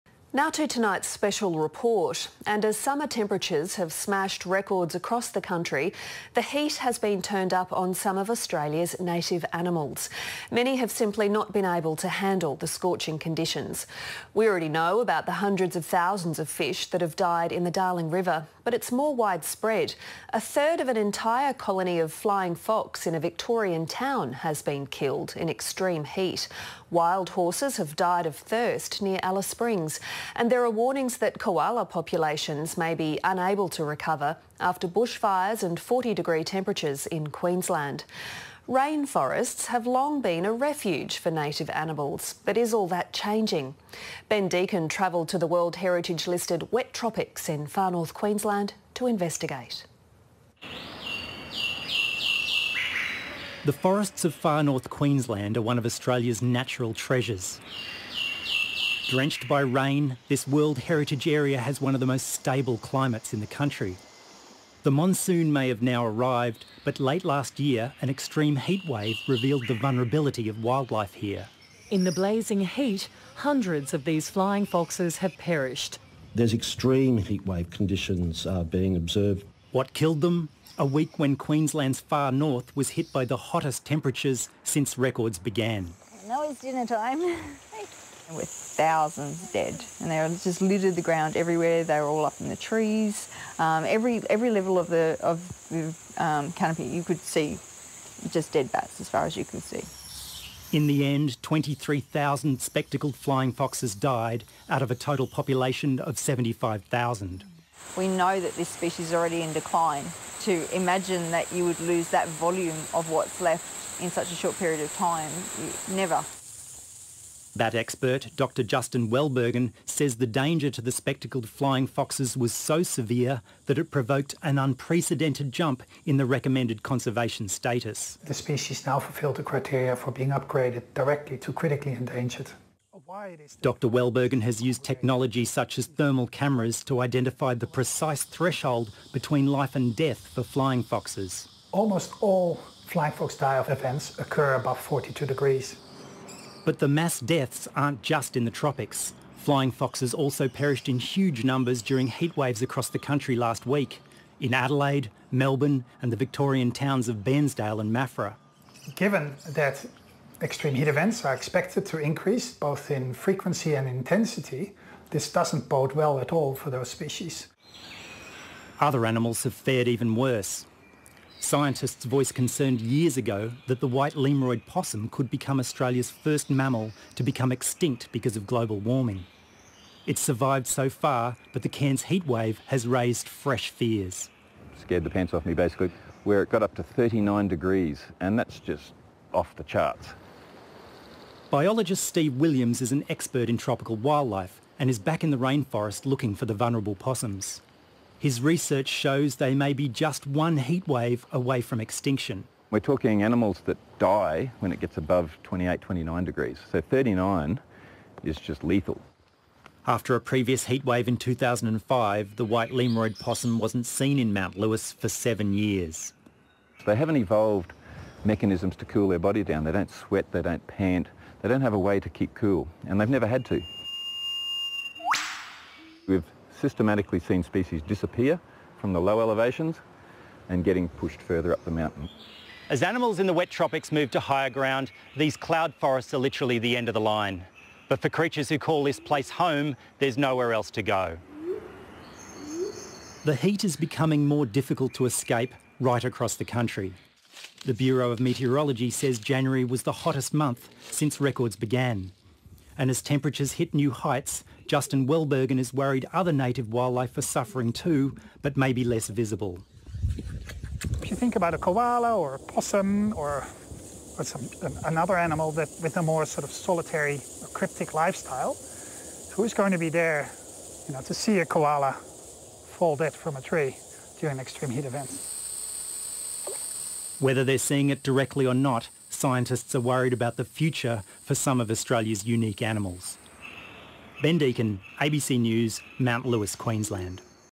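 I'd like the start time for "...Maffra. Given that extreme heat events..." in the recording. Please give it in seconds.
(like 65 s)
157 s.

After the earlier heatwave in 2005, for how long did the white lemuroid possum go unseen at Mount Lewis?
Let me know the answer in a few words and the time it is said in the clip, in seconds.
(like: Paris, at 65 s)
7 years, at 215 s.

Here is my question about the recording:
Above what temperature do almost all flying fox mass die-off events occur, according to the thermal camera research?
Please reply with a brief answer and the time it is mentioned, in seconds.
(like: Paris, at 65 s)
42 degrees, at 144 s.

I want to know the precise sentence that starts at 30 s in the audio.
And there are warnings that koala populations may be unable to recover after bushfires and 40 degree temperatures in Queensland.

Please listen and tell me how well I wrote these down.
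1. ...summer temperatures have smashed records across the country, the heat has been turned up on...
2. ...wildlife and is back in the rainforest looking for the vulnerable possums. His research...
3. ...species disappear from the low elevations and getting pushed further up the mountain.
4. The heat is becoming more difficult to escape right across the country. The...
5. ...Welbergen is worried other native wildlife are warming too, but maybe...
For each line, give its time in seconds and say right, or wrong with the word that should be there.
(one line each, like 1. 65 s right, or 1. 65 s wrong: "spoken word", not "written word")
1. 2 s right
2. 193 s right
3. 227 s right
4. 243 s right
5. 255 s wrong: "suffering", not "warming".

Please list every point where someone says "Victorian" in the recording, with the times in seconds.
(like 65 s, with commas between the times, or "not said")
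23 s, 156 s.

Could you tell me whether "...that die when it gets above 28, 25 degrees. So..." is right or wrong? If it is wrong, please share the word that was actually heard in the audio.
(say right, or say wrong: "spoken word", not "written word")
wrong: "29", not "25".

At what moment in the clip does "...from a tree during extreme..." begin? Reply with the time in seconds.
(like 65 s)
273 s.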